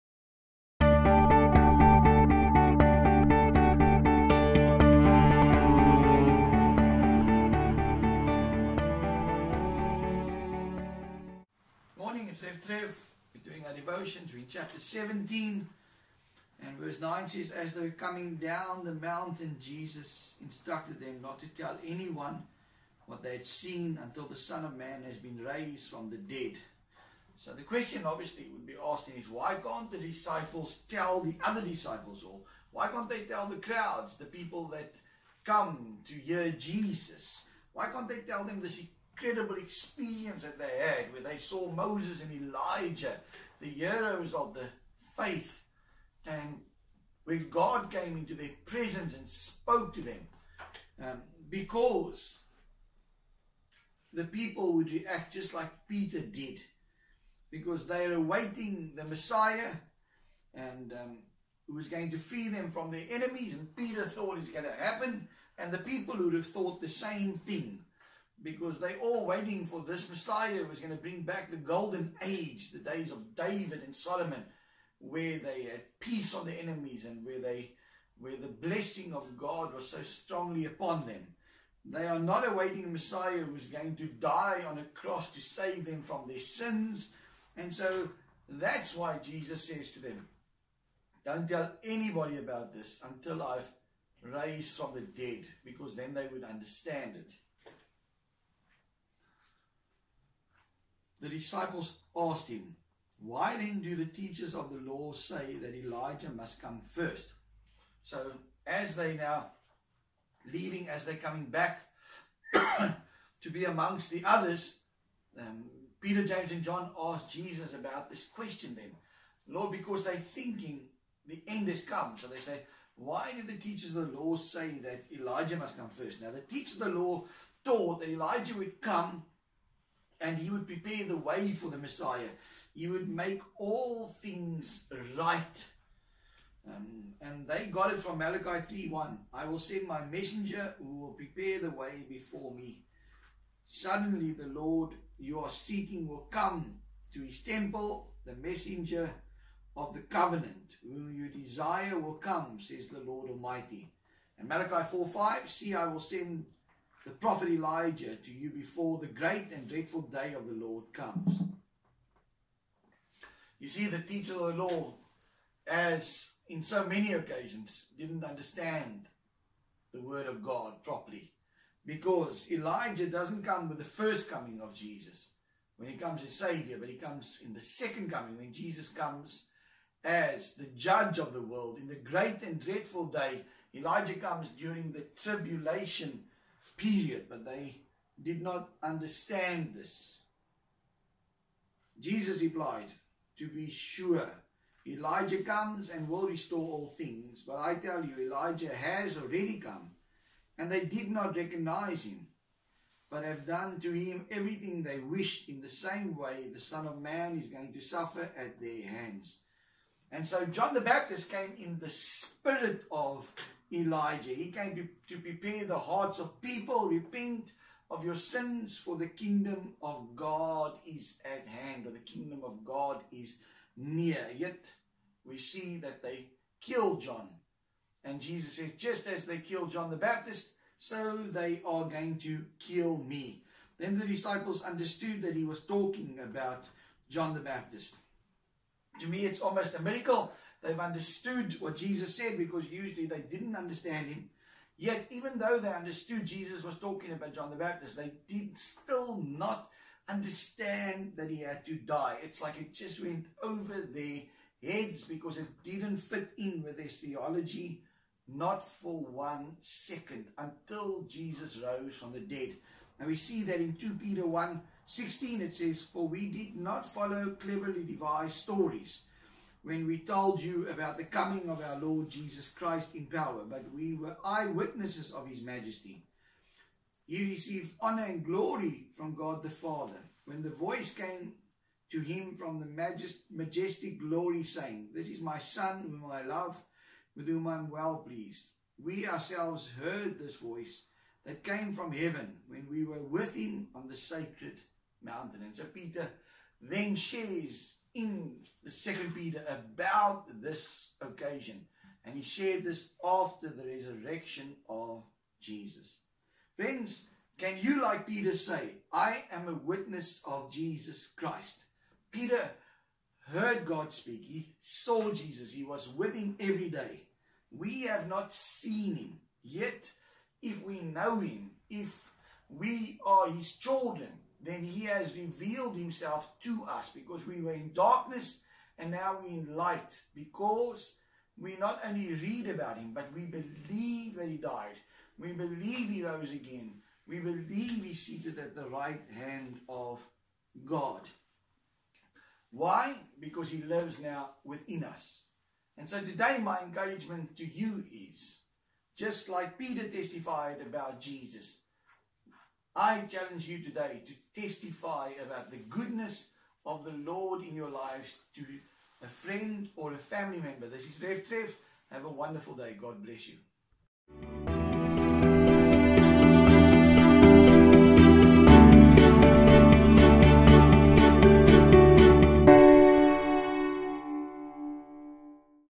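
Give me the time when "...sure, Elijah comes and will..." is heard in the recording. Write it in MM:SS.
03:13.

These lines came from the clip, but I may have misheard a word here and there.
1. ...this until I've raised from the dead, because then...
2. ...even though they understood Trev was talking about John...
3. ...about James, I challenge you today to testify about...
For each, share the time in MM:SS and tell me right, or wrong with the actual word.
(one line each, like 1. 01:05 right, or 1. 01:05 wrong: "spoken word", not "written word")
1. 01:32 right
2. 04:05 wrong: "Jesus", not "Trev"
3. 05:50 wrong: "Jesus", not "James".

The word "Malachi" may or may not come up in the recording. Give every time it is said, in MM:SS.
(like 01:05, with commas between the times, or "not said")
02:18, 02:34.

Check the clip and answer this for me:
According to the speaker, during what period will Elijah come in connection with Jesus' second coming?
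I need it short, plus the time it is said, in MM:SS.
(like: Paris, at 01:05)
the tribulation period, at 03:04.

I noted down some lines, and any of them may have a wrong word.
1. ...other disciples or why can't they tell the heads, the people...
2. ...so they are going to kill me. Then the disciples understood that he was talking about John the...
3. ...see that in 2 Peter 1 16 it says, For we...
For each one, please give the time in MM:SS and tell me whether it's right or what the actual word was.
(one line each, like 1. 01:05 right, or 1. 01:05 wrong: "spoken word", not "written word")
1. 00:31 wrong: "crowds", not "heads"
2. 03:50 right
3. 04:23 right.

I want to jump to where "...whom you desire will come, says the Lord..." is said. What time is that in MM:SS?
02:30.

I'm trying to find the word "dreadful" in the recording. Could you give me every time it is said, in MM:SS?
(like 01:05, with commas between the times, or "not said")
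02:39, 03:02.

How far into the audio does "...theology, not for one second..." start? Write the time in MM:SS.
04:16.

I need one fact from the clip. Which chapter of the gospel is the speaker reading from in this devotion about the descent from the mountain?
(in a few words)
17.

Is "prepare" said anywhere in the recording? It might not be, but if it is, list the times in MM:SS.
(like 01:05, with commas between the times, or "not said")
02:10, 02:21, 03:35.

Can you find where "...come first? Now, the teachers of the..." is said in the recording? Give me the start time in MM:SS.
02:05.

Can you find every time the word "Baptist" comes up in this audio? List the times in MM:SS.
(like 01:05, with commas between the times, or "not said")
03:30, 03:49, 03:57, 04:07.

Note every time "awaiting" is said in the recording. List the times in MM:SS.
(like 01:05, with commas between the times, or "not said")
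00:58, 01:22.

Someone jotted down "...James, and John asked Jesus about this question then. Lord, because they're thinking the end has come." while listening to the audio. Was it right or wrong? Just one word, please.
right.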